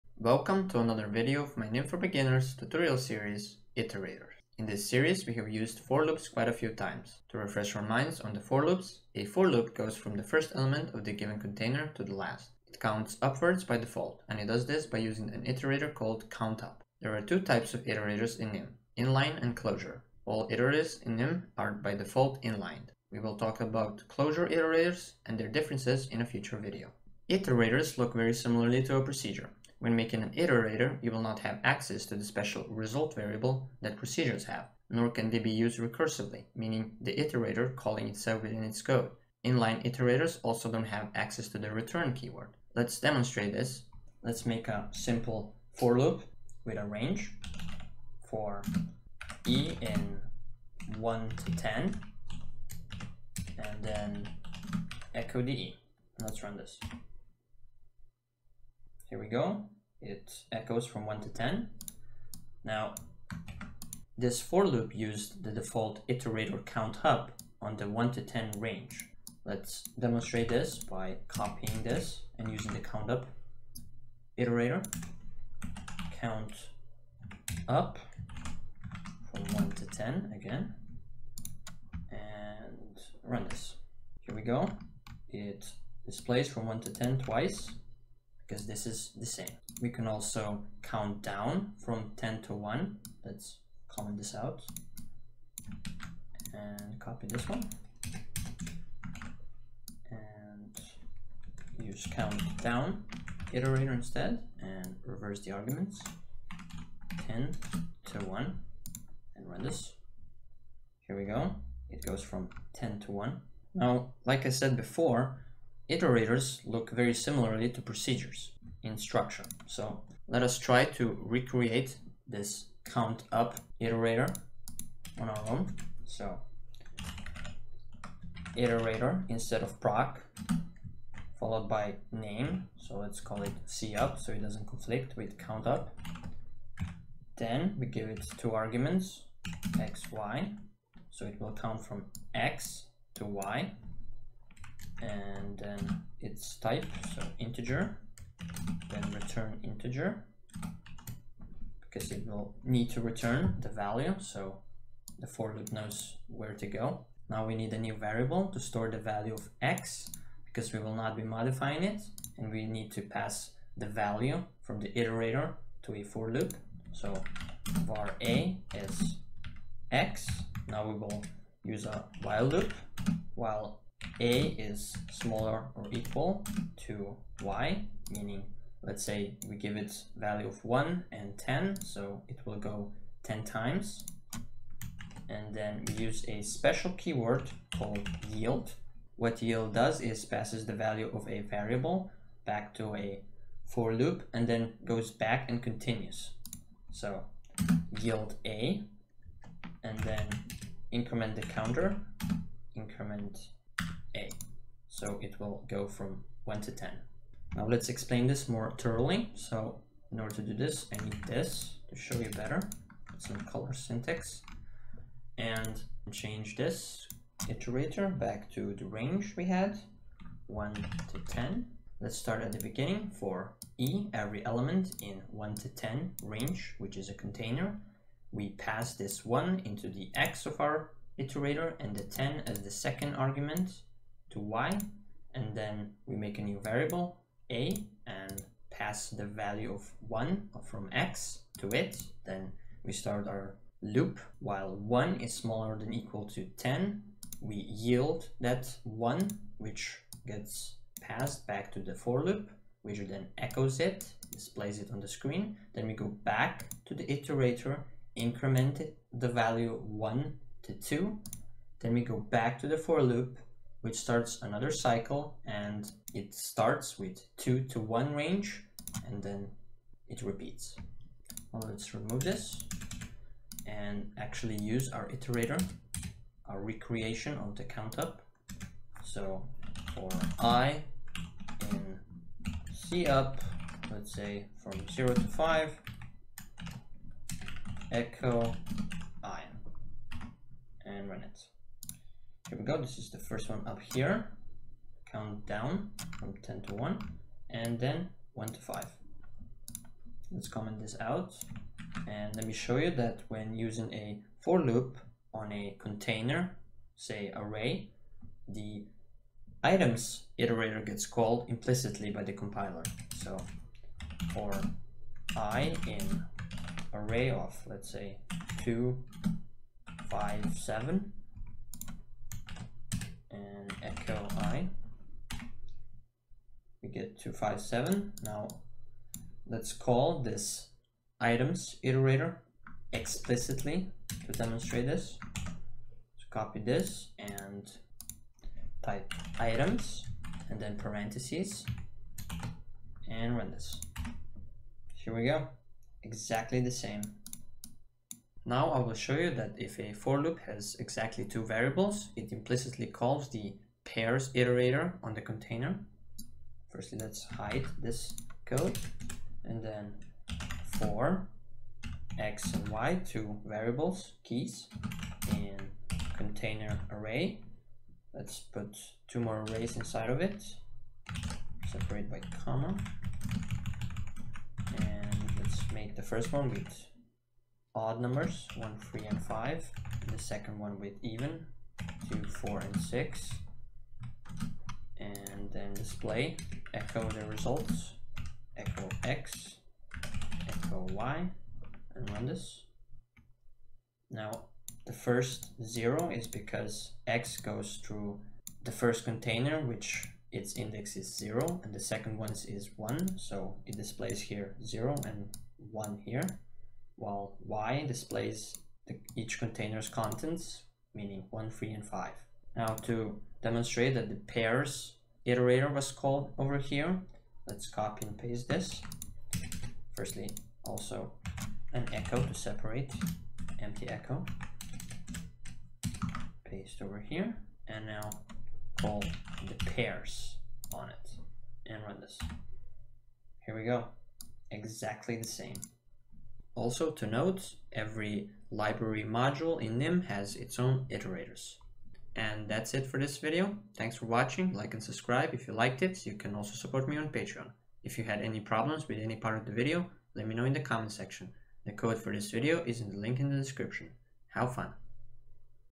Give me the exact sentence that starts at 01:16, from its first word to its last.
Count up from 1 to 10 again and run this.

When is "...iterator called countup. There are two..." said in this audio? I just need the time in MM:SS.
00:15.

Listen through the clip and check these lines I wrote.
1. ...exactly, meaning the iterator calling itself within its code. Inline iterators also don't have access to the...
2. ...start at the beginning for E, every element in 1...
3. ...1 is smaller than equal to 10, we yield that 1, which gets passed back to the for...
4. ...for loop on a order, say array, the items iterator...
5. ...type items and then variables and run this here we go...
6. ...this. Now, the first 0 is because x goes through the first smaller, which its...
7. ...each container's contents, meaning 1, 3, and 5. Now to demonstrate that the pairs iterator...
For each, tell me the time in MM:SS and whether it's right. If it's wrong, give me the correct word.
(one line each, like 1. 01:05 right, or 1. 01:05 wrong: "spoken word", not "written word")
1. 00:35 wrong: "recursively", not "exactly"
2. 03:42 right
3. 04:04 right
4. 05:04 wrong: "container", not "order"
5. 05:38 wrong: "parentheses", not "variables"
6. 06:32 wrong: "container", not "smaller"
7. 06:49 right.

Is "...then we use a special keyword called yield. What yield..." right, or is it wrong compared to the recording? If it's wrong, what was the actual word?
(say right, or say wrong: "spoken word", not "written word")
right.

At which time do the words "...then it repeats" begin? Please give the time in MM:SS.
04:29.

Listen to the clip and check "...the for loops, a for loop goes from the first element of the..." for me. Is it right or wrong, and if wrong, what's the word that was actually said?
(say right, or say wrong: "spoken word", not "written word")
right.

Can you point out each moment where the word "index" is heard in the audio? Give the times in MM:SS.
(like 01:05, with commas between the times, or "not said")
06:40.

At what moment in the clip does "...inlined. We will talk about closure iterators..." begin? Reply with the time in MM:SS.
00:22.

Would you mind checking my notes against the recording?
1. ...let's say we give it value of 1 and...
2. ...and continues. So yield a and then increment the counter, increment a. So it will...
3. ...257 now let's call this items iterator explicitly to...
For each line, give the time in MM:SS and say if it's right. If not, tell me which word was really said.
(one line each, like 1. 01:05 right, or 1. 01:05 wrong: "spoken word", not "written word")
1. 02:58 right
2. 03:15 right
3. 05:27 right.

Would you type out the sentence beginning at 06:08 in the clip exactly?
Let's put two more arrays inside of it, separate by comma.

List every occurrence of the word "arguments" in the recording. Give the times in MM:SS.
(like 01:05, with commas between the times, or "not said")
01:45, 02:18, 03:53.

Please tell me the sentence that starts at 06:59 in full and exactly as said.
Firstly, also an echo to separate, empty echo.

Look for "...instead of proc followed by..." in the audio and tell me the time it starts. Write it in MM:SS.
02:09.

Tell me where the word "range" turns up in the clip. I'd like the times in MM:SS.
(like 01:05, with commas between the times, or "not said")
00:46, 01:08, 03:38, 03:46, 04:28.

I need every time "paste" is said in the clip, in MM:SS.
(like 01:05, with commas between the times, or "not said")
06:58, 07:06.